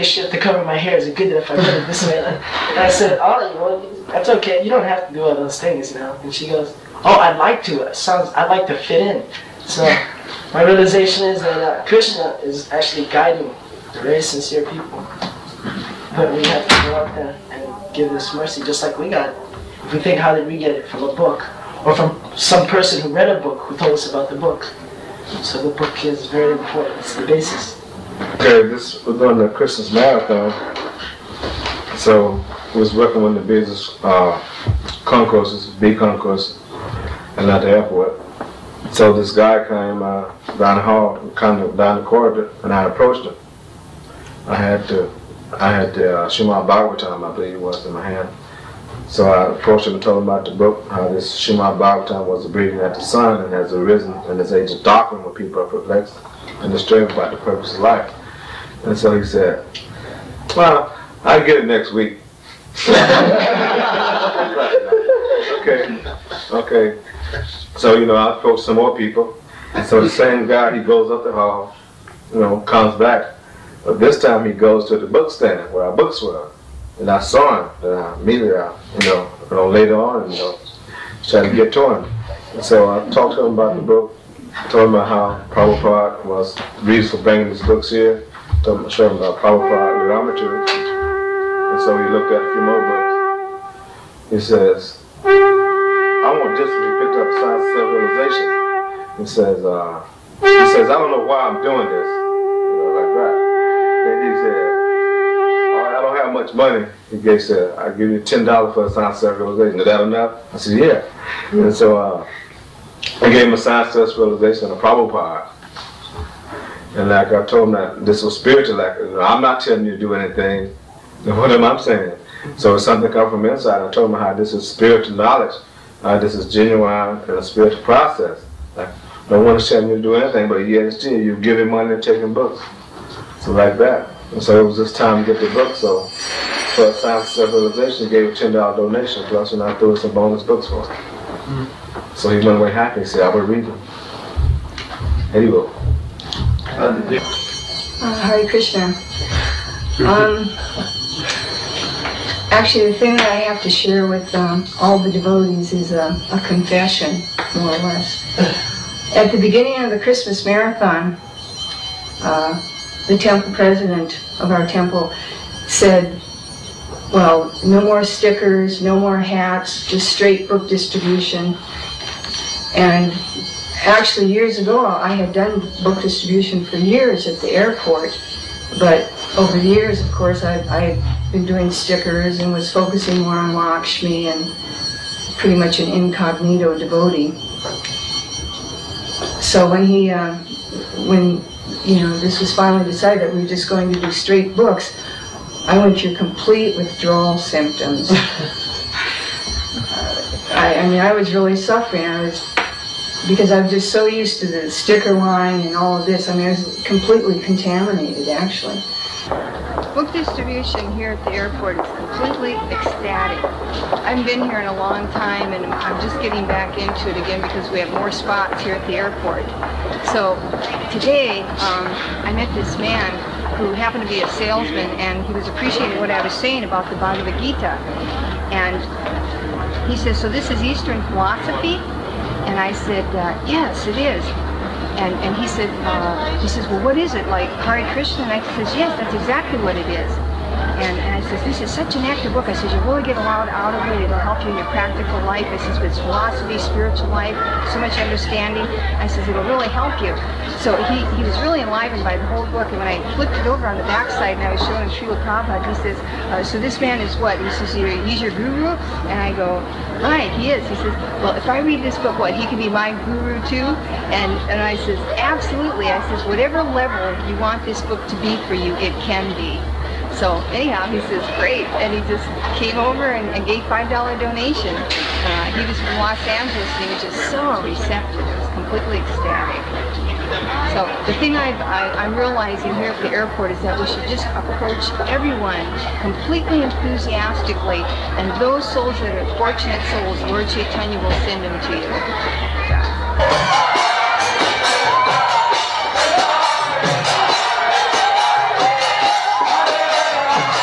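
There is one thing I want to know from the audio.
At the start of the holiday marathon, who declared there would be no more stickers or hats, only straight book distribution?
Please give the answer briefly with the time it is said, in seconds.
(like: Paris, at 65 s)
temple president, at 163 s.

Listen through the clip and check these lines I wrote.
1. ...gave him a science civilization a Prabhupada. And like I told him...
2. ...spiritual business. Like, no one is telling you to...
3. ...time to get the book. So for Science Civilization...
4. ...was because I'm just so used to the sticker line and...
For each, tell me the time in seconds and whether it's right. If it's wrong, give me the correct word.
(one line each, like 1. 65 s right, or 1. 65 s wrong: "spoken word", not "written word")
1. 113 s right
2. 127 s wrong: "process", not "business"
3. 134 s right
4. 202 s right.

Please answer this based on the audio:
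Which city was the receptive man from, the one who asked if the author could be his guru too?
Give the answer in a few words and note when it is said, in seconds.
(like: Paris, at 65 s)
Los Angeles, at 275 s.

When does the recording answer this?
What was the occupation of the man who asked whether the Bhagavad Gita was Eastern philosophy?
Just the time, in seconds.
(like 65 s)
224 s.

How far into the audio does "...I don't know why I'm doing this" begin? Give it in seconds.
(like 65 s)
100 s.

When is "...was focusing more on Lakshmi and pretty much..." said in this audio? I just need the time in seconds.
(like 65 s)
182 s.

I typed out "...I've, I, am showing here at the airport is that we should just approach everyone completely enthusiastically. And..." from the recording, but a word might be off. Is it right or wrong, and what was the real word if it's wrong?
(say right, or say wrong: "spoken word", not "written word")
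wrong: "realizing", not "showing".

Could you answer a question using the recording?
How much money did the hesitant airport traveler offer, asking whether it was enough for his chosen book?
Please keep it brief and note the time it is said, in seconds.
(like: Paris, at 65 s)
$10, at 108 s.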